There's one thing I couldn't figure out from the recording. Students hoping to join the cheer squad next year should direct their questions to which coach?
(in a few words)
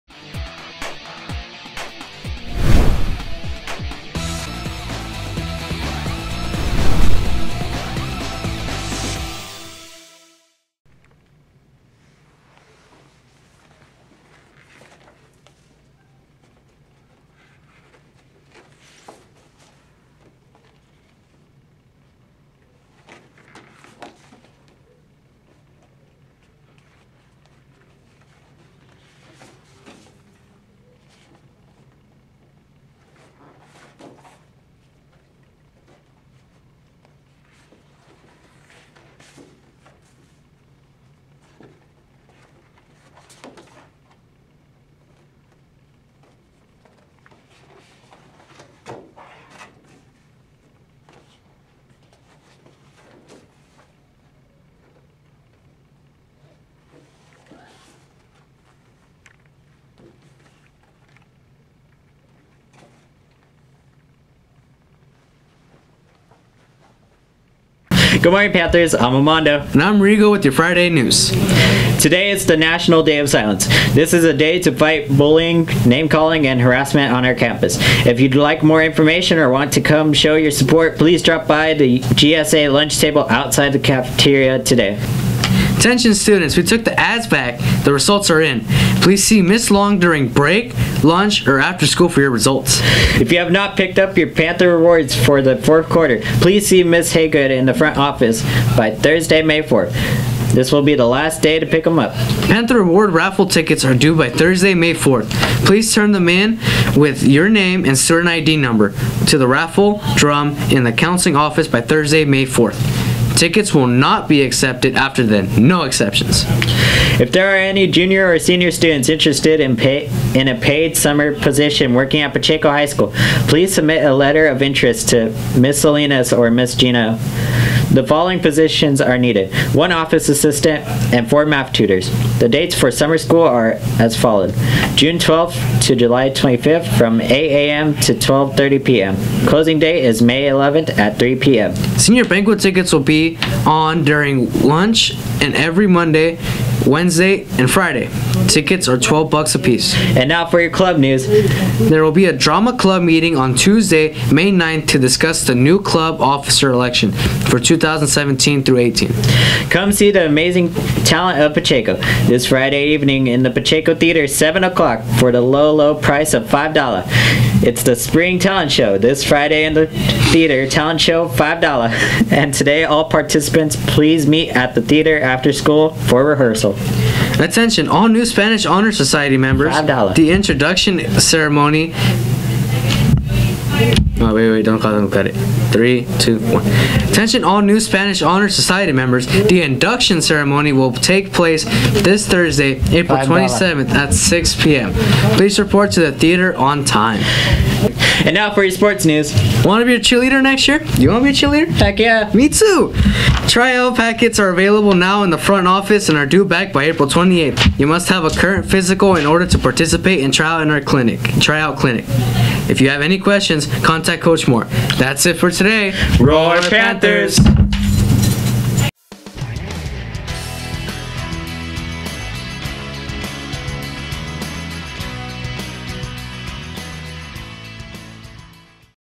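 Coach Moore.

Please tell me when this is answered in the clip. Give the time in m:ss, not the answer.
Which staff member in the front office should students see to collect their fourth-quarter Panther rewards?
1:36.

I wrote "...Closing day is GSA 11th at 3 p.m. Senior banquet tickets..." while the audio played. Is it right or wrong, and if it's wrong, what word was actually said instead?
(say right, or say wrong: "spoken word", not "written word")
wrong: "May", not "GSA".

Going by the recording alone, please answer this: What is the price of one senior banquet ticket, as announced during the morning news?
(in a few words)
$12.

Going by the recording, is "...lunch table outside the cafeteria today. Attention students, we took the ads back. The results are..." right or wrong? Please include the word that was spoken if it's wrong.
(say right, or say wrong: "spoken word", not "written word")
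right.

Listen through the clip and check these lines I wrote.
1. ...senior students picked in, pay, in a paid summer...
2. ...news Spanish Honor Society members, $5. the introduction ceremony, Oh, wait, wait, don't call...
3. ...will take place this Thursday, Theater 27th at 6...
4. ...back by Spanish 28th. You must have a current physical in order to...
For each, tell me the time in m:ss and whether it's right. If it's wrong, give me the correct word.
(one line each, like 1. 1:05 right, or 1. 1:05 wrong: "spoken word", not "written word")
1. 1:58 wrong: "interested", not "picked"
2. 2:58 right
3. 3:10 wrong: "April", not "Theater"
4. 3:26 wrong: "April", not "Spanish".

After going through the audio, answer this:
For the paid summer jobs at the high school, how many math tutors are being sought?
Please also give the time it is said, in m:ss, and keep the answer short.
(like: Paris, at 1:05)
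4, at 2:11.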